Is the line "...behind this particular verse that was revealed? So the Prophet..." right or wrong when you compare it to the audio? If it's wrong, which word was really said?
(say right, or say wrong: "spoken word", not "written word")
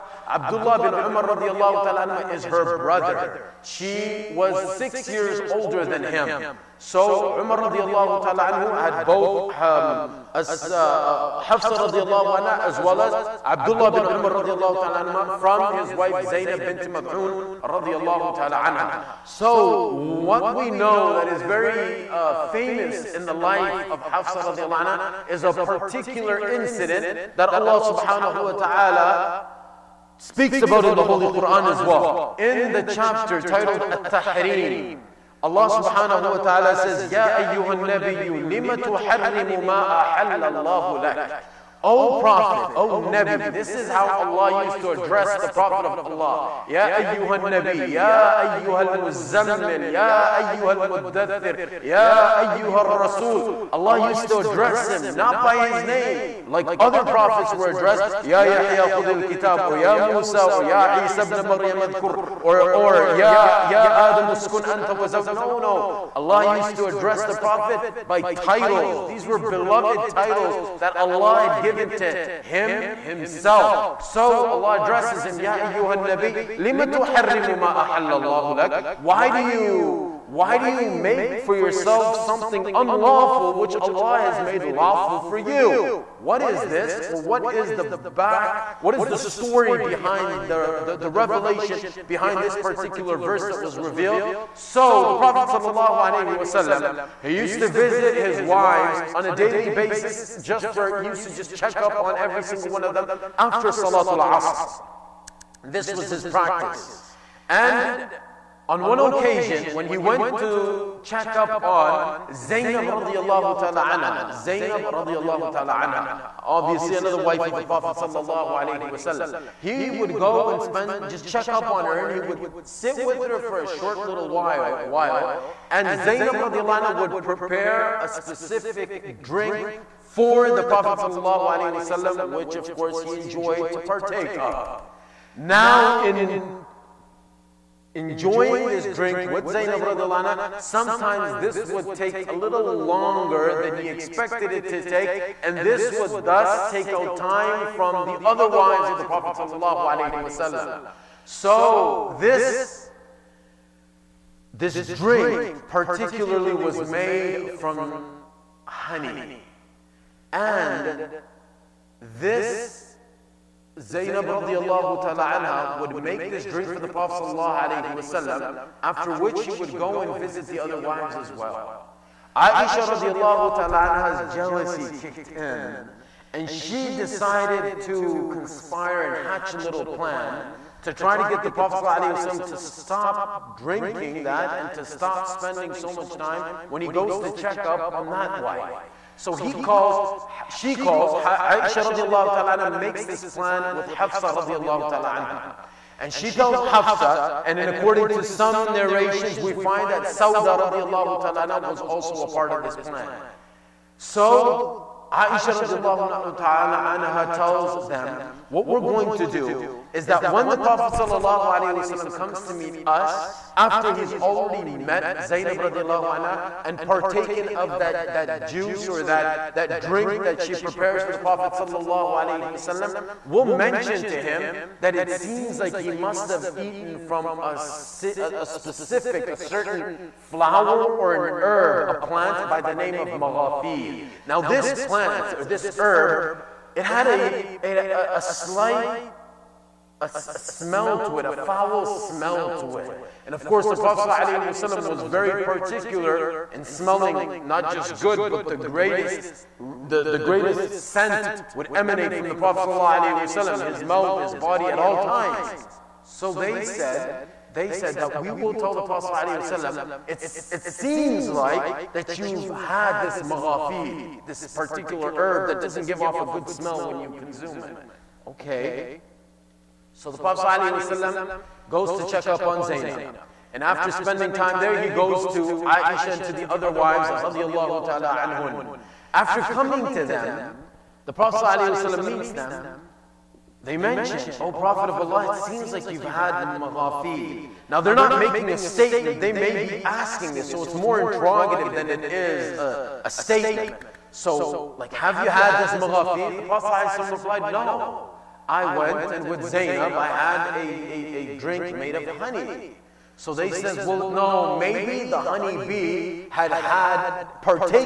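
right.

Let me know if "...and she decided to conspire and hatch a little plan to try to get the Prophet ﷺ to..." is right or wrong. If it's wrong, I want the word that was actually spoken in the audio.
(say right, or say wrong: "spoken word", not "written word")
right.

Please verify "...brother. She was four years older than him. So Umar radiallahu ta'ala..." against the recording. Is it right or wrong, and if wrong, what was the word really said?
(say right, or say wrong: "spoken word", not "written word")
wrong: "six", not "four".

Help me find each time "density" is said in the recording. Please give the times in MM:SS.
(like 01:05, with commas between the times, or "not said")
not said.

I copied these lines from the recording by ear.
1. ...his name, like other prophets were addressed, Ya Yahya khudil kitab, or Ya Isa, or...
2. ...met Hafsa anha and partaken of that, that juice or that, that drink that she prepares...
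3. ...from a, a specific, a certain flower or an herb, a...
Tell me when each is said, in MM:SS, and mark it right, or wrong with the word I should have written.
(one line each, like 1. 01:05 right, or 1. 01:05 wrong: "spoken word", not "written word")
1. 00:55 wrong: "Musa", not "Isa"
2. 03:34 wrong: "Zainab", not "Hafsa"
3. 03:46 right.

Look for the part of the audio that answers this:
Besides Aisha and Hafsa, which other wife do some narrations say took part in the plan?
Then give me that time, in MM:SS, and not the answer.
03:20.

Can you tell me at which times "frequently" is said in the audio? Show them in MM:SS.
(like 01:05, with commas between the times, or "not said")
not said.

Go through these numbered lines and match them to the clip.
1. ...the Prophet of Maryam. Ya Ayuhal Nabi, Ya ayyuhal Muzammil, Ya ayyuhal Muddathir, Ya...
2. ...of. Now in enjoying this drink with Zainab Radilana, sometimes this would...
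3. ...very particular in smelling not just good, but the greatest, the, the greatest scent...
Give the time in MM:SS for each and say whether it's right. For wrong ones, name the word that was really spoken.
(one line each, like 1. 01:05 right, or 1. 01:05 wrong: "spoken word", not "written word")
1. 00:45 wrong: "Allah", not "Maryam"
2. 02:14 right
3. 04:05 right.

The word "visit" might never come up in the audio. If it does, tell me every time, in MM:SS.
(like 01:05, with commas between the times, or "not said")
01:37, 02:50.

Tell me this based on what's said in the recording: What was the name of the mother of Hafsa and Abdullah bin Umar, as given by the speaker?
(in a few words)
Zainab bint Mad'un.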